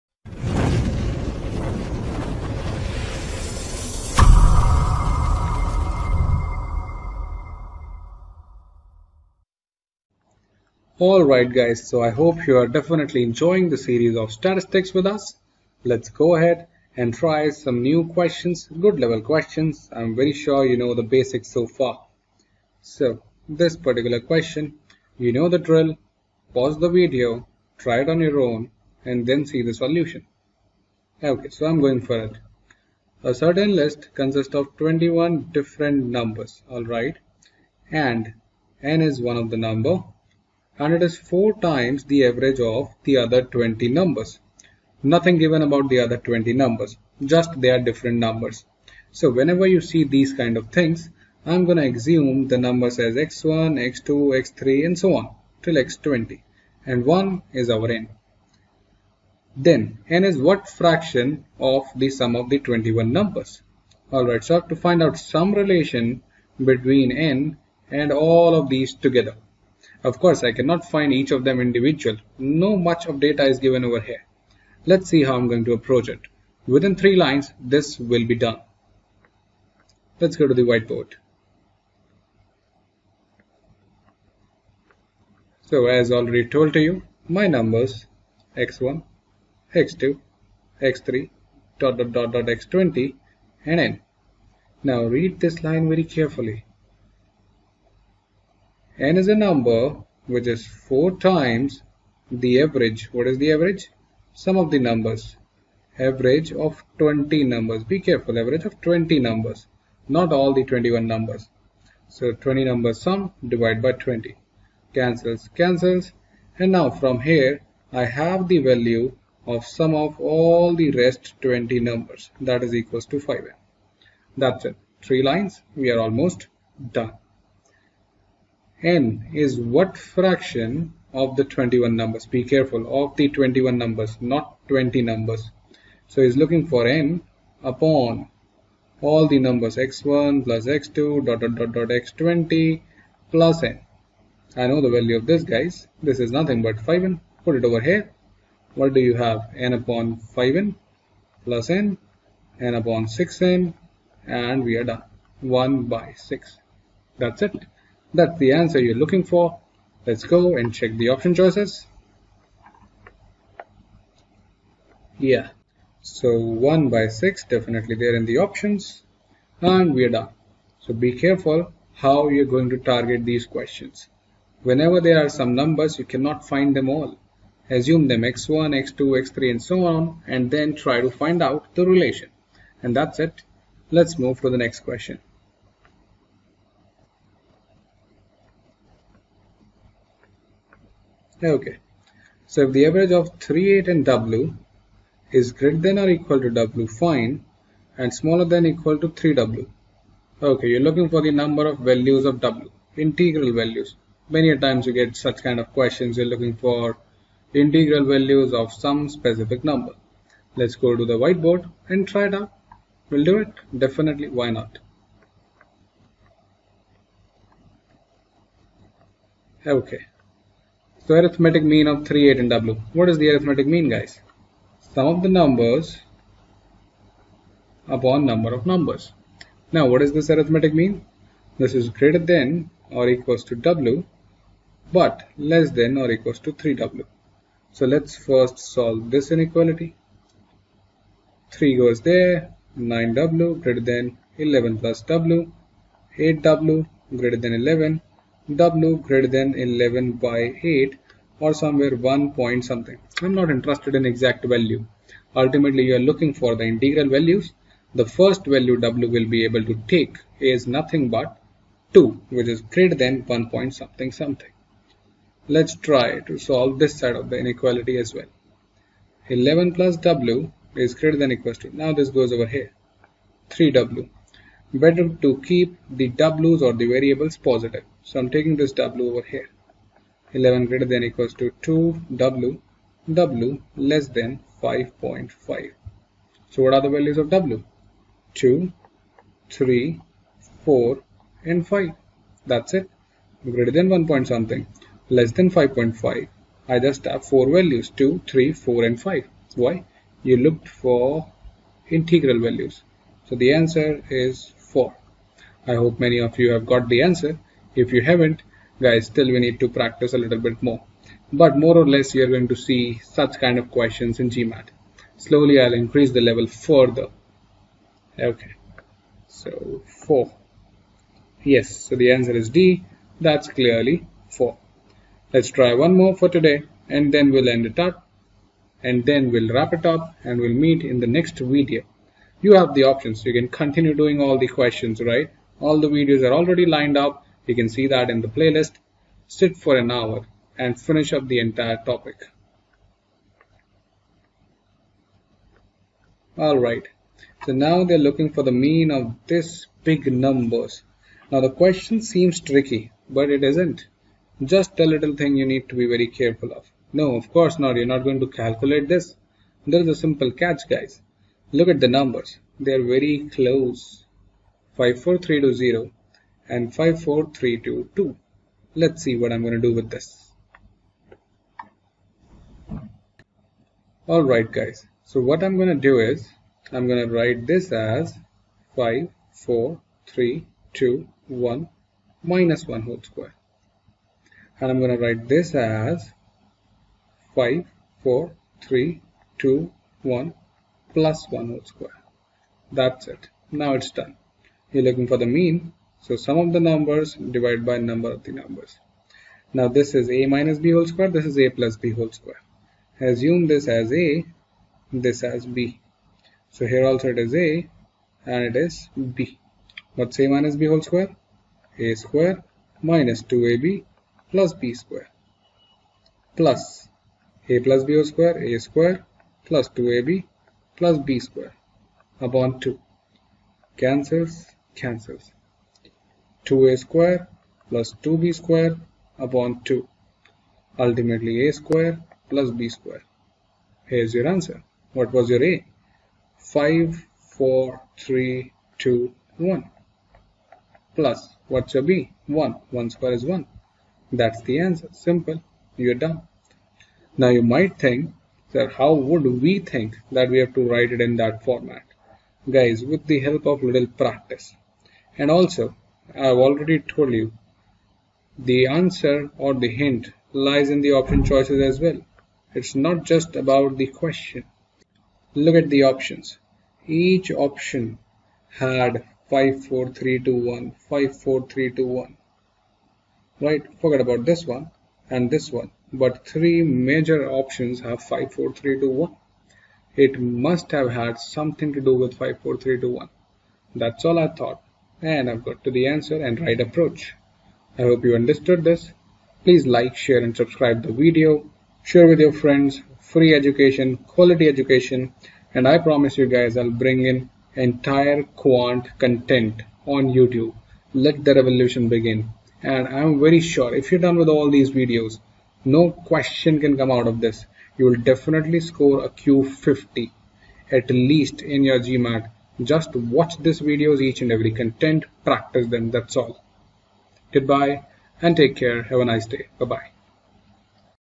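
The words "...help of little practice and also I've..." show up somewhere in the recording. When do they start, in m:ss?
7:33.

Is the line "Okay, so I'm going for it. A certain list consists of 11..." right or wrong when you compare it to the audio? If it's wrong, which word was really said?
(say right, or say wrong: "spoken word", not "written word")
wrong: "21", not "11".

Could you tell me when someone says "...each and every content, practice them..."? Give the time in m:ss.
8:34.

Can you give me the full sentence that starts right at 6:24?
And I'm going to write this as five, four, three, two, one plus 1, plus 1 whole square.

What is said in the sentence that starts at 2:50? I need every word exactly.
So be careful how you're going to target these questions.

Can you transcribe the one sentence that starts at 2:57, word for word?
Assume them x1, x2, x3 and so on and then try to find out the relation.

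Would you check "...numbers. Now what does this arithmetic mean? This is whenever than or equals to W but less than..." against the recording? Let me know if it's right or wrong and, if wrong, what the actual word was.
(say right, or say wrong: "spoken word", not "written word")
wrong: "greater", not "whenever".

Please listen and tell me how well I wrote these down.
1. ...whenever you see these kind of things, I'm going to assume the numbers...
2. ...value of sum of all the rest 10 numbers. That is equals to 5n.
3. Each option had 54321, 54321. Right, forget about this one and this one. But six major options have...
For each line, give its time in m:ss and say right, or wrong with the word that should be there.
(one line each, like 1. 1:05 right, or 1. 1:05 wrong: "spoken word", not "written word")
1. 0:49 right
2. 1:58 wrong: "20", not "10"
3. 7:46 wrong: "three", not "six".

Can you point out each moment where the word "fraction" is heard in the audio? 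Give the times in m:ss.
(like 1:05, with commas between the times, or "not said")
1:00, 2:09.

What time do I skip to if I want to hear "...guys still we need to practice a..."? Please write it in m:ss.
5:08.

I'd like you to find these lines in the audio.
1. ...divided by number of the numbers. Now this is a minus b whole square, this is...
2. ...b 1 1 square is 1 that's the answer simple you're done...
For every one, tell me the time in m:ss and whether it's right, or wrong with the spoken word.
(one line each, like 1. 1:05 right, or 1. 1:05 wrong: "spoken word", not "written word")
1. 6:37 right
2. 7:21 right.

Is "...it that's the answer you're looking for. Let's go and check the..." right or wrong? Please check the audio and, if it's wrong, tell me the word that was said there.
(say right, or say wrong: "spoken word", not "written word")
right.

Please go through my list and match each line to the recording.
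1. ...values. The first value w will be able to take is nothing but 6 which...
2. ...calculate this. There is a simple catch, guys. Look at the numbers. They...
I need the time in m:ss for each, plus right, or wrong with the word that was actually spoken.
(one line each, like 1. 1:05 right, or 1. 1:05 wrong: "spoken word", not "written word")
1. 4:17 wrong: "2", not "6"
2. 5:58 right.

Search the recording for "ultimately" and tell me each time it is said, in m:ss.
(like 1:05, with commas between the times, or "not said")
4:15, 7:10.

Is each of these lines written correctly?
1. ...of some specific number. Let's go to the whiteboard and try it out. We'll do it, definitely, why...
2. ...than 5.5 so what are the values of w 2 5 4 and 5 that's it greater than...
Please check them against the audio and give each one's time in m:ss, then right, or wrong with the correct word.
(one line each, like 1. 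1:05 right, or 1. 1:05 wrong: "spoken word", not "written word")
1. 3:28 right
2. 4:44 wrong: "3", not "5".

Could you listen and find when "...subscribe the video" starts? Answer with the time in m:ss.
8:10.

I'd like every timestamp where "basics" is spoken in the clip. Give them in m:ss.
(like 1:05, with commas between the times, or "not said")
0:21.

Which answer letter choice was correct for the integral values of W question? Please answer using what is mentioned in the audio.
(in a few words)
D.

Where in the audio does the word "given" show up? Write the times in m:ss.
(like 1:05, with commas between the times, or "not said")
0:45, 1:13.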